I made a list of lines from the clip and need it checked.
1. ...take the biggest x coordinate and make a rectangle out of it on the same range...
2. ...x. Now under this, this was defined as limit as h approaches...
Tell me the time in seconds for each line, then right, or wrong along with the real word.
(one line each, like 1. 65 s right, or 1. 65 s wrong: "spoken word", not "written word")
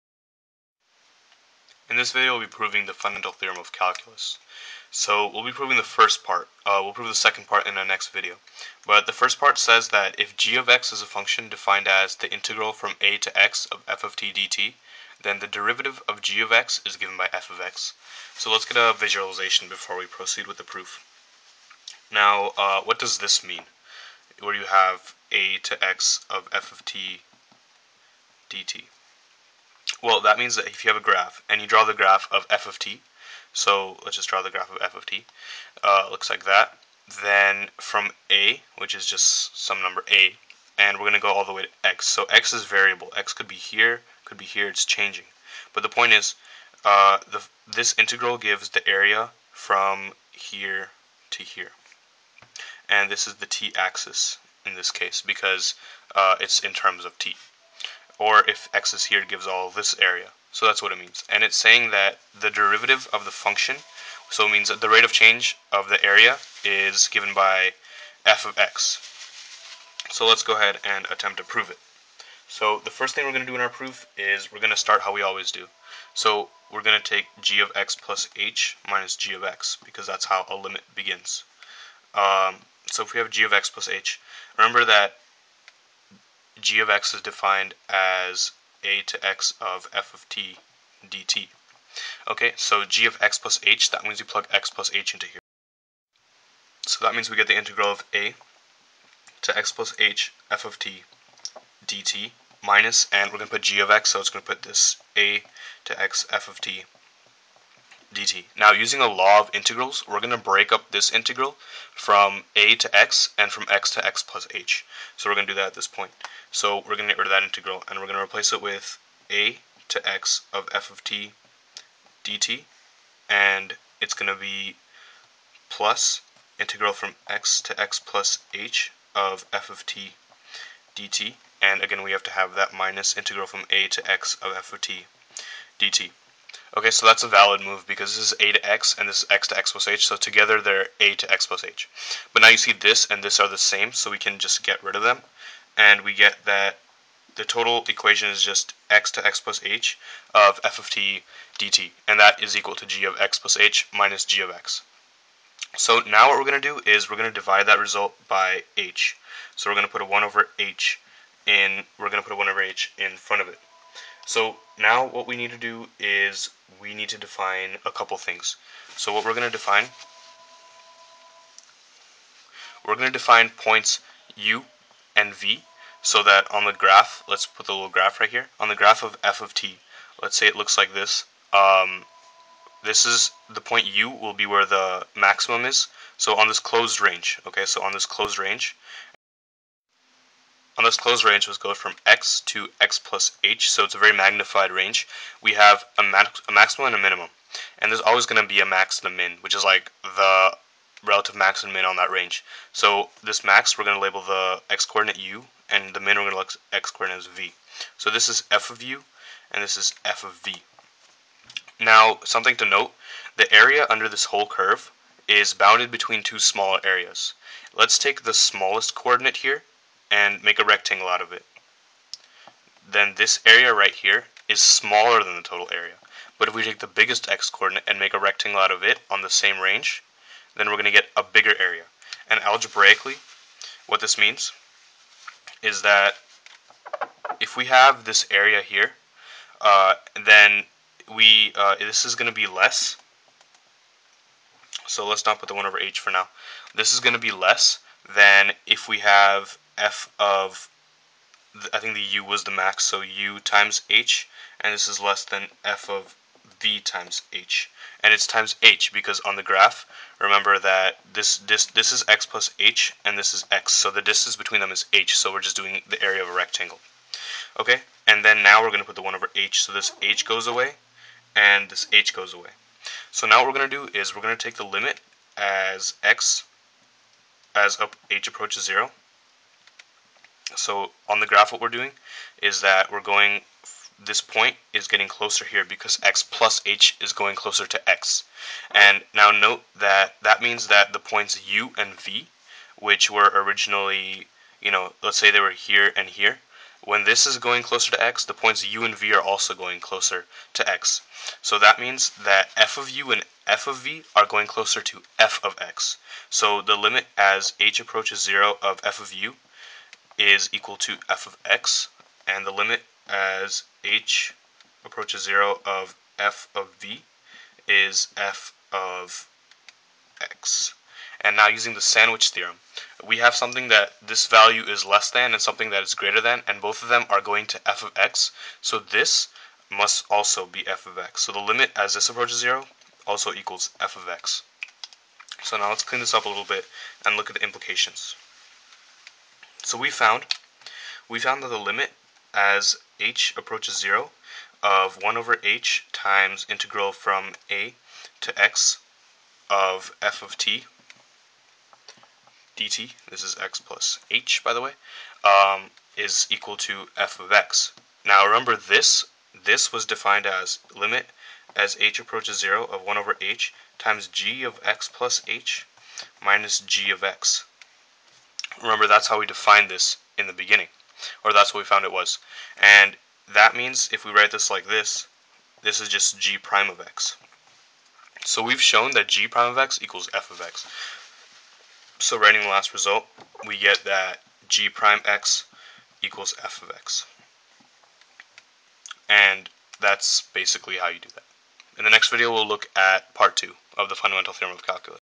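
1. 226 s right
2. 357 s wrong: "remember", not "under".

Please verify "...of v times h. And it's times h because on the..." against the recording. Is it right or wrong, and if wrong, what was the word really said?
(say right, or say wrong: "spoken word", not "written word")
right.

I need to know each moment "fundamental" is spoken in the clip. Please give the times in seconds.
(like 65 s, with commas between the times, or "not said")
2 s, 393 s.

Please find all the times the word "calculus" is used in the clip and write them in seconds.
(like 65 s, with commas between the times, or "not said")
3 s, 394 s.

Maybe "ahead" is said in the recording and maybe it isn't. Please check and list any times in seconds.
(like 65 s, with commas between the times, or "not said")
70 s.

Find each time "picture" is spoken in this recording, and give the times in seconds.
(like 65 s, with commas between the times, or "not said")
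not said.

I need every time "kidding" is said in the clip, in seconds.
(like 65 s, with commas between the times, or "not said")
not said.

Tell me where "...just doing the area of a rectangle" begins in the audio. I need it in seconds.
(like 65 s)
265 s.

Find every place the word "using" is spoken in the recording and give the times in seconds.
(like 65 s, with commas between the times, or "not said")
108 s, 321 s.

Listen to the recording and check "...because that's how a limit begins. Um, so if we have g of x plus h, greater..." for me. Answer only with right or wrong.
wrong.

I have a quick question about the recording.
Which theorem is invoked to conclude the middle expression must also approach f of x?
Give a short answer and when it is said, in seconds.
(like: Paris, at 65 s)
sandwich theorem, at 321 s.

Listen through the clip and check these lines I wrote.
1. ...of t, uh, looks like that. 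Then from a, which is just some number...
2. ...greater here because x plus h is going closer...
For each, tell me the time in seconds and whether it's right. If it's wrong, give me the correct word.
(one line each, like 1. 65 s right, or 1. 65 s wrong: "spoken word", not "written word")
1. 34 s right
2. 285 s wrong: "closer", not "greater".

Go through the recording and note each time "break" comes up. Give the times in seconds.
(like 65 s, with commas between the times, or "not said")
110 s.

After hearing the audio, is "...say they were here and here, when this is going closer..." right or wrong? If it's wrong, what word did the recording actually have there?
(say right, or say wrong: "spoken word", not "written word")
right.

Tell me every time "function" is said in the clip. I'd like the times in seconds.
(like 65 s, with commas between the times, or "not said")
11 s, 63 s.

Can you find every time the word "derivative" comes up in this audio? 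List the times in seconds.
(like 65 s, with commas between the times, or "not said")
15 s, 62 s.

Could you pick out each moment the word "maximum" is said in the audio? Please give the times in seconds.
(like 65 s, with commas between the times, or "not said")
185 s, 196 s.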